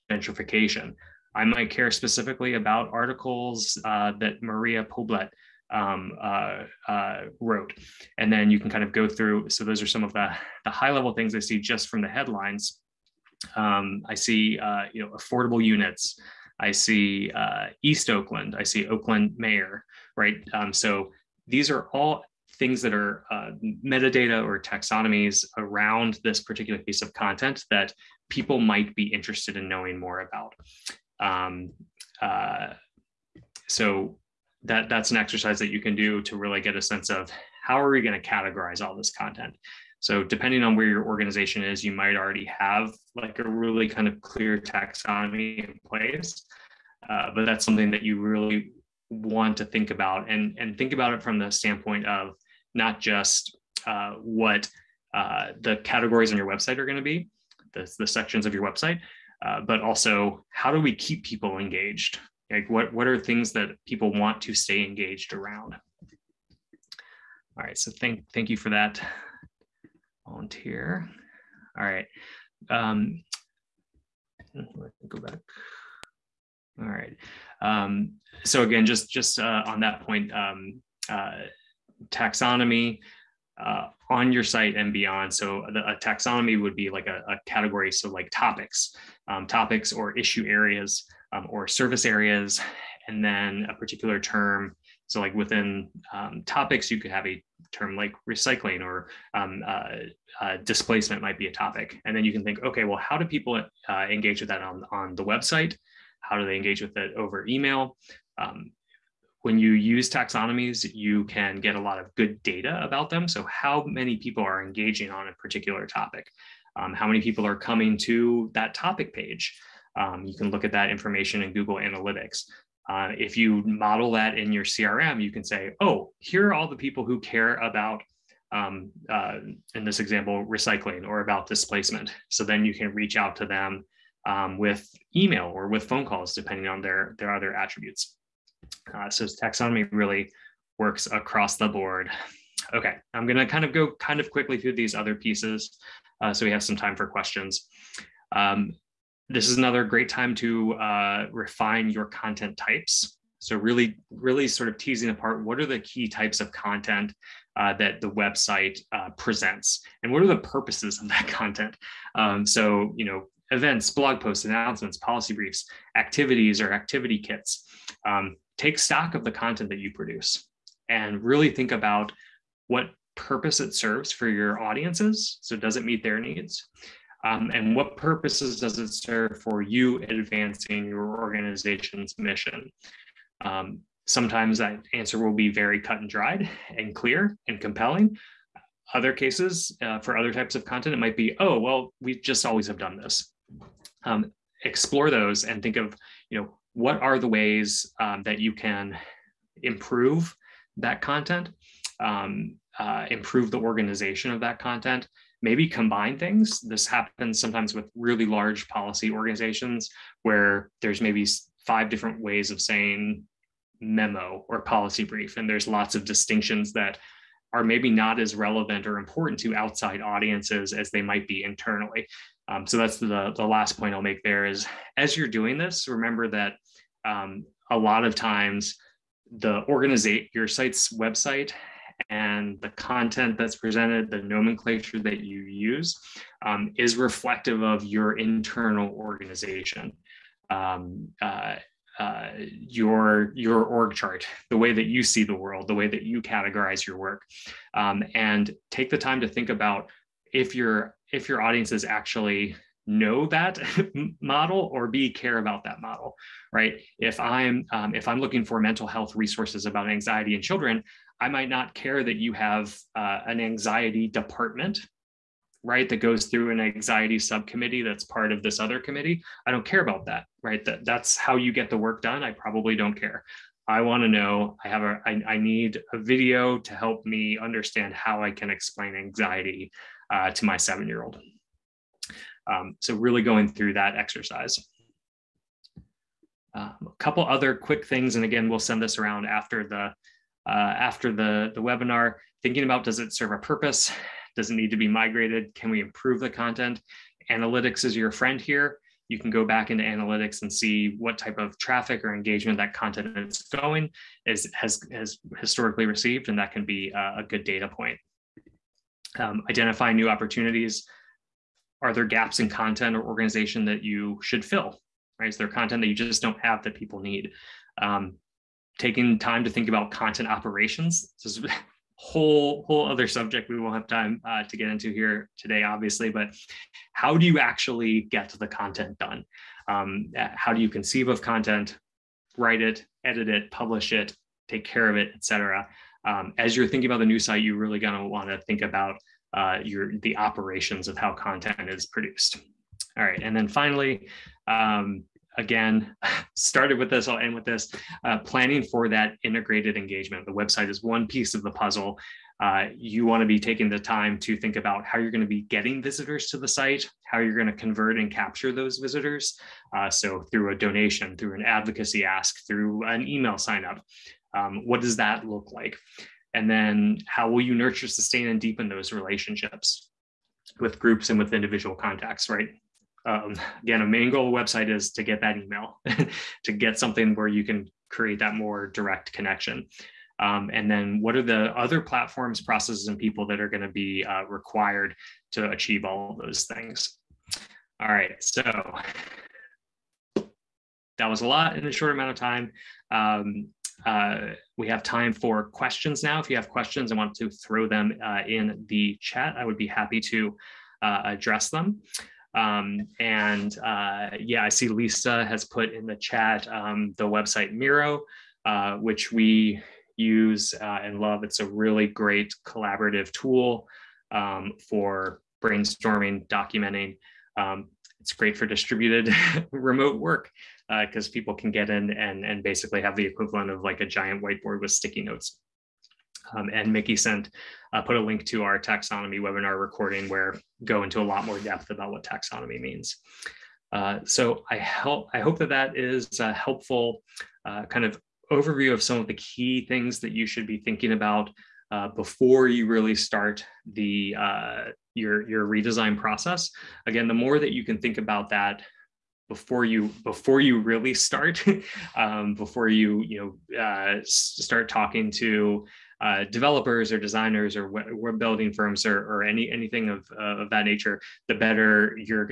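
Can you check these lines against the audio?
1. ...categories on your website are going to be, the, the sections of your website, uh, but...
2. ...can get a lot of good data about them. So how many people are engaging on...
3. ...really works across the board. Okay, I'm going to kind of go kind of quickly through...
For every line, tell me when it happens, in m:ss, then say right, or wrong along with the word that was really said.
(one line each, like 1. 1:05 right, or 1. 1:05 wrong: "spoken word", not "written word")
1. 0:55 right
2. 1:51 right
3. 2:19 right.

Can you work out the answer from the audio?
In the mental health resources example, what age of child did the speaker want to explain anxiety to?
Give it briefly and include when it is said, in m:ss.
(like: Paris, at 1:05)
7, at 4:40.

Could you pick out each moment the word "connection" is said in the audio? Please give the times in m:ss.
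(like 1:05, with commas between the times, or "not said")
6:19.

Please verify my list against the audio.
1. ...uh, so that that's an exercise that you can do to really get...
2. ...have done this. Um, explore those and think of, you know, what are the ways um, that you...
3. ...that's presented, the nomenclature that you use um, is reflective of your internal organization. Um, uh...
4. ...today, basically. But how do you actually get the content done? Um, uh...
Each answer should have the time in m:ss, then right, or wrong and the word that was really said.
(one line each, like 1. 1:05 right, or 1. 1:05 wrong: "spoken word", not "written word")
1. 0:32 right
2. 3:12 right
3. 3:53 right
4. 5:25 wrong: "obviously", not "basically".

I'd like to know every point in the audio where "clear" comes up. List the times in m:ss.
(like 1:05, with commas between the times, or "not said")
0:44, 3:06.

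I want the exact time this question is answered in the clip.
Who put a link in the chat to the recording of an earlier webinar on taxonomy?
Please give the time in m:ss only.
7:06.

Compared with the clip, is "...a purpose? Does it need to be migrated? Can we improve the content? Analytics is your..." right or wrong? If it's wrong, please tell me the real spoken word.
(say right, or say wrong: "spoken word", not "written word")
right.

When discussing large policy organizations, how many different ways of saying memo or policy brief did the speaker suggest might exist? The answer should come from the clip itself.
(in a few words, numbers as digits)
5.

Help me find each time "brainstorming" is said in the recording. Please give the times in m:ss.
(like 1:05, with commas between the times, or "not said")
6:55.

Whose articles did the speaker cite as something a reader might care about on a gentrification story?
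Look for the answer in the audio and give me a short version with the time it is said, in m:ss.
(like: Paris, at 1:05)
Maria Poblet, at 0:04.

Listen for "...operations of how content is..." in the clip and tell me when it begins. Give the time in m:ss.
5:40.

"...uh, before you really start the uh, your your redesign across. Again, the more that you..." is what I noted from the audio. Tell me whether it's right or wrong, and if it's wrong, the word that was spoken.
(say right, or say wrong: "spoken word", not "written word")
wrong: "process", not "across".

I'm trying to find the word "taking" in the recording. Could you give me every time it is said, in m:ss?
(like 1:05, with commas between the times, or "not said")
5:18, 5:53.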